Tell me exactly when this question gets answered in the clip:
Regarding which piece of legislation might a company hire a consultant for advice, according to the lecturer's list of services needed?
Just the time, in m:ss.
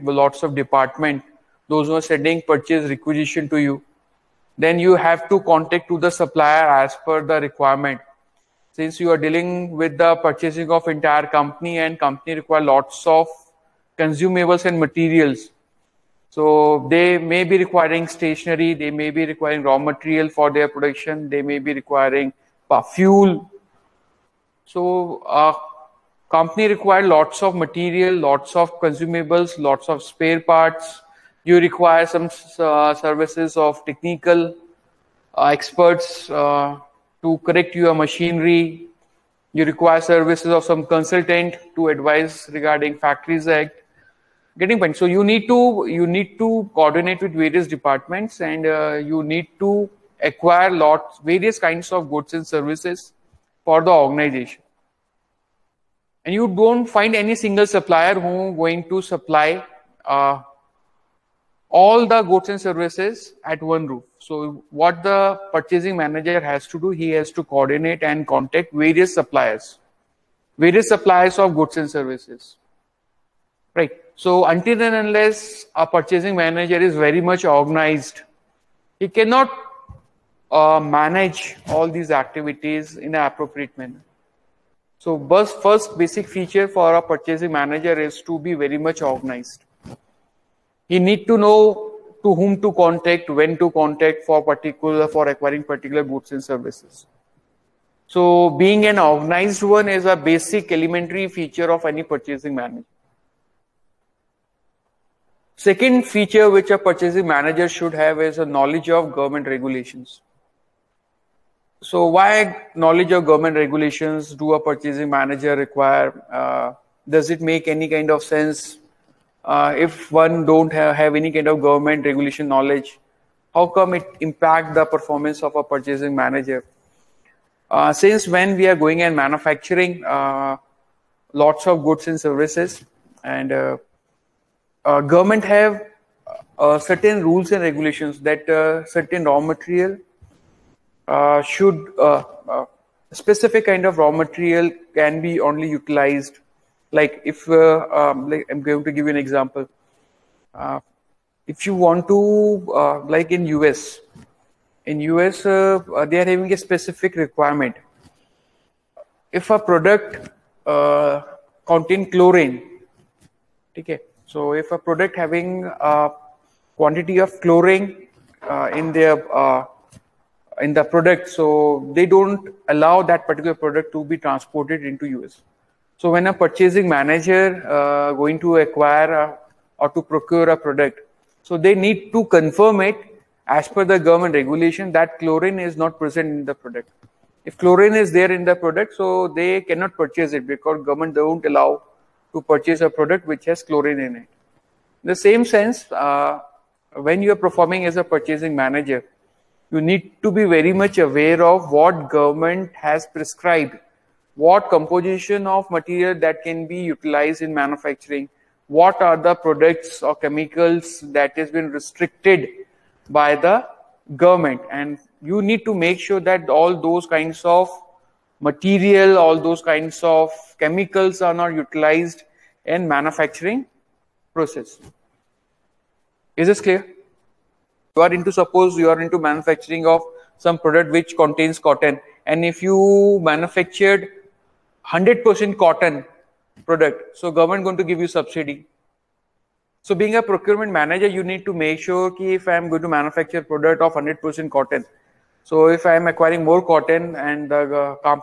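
0:42.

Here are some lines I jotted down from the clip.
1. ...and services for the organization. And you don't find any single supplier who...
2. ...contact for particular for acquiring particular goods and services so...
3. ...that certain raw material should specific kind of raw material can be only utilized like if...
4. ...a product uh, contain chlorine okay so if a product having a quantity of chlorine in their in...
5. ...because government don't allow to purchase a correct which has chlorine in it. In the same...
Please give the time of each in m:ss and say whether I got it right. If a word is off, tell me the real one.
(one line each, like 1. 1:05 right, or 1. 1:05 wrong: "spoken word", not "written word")
1. 0:52 right
2. 1:33 right
3. 2:18 right
4. 2:39 right
5. 3:10 wrong: "product", not "correct".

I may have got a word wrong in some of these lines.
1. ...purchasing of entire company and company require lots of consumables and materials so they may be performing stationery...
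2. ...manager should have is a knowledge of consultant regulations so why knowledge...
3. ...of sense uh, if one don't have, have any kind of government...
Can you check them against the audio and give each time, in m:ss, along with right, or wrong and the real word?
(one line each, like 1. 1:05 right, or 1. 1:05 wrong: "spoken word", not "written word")
1. 0:10 wrong: "requiring", not "performing"
2. 1:47 wrong: "government", not "consultant"
3. 1:58 right.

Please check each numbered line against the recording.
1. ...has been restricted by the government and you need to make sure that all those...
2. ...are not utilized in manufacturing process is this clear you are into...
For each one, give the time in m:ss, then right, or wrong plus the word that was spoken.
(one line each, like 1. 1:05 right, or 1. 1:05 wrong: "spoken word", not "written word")
1. 3:31 right
2. 3:41 right.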